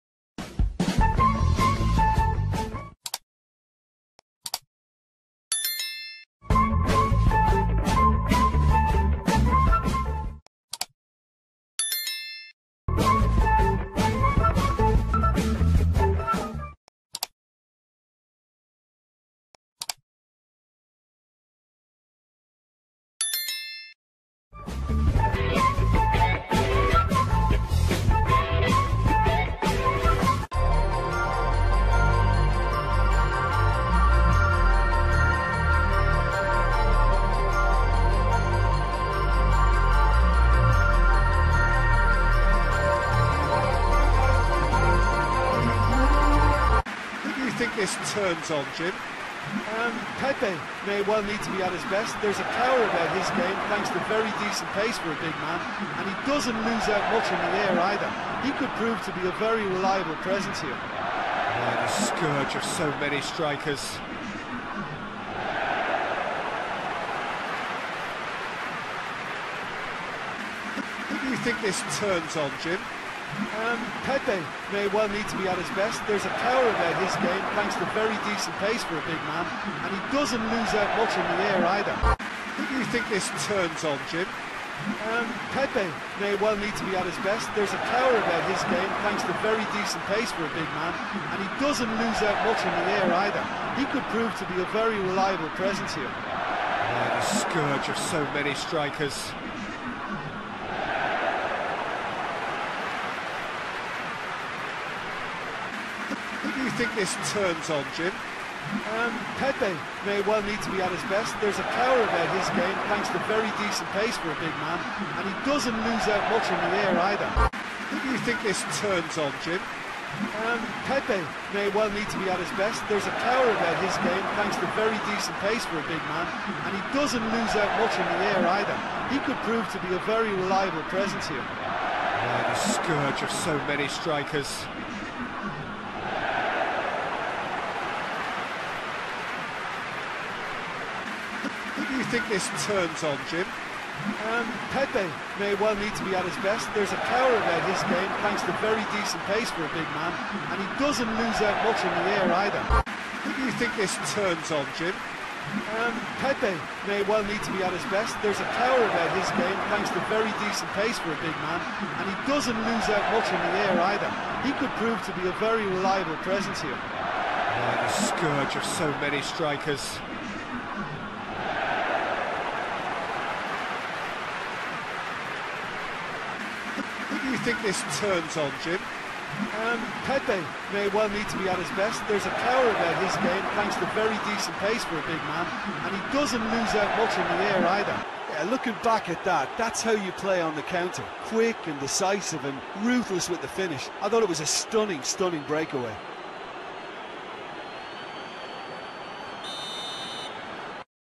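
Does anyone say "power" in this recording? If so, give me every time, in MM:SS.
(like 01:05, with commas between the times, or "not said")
00:52, 01:16, 01:27, 01:51, 02:03, 02:27, 02:38, 03:02.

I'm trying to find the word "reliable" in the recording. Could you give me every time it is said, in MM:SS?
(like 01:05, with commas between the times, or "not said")
00:59, 01:35, 02:10, 02:45.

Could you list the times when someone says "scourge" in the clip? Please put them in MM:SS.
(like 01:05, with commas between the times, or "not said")
01:01, 01:37, 02:12, 02:47.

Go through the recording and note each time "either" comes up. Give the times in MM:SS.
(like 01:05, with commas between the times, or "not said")
00:57, 01:21, 01:33, 01:57, 02:08, 02:32, 02:43, 03:07.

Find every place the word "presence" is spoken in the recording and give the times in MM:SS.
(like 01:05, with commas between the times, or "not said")
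01:00, 01:35, 02:10, 02:46.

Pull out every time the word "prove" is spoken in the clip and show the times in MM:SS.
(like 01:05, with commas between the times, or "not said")
00:58, 01:34, 02:09, 02:44.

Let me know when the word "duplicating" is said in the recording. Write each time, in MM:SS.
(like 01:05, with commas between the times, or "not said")
not said.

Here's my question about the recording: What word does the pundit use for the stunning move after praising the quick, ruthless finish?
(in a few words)
breakaway.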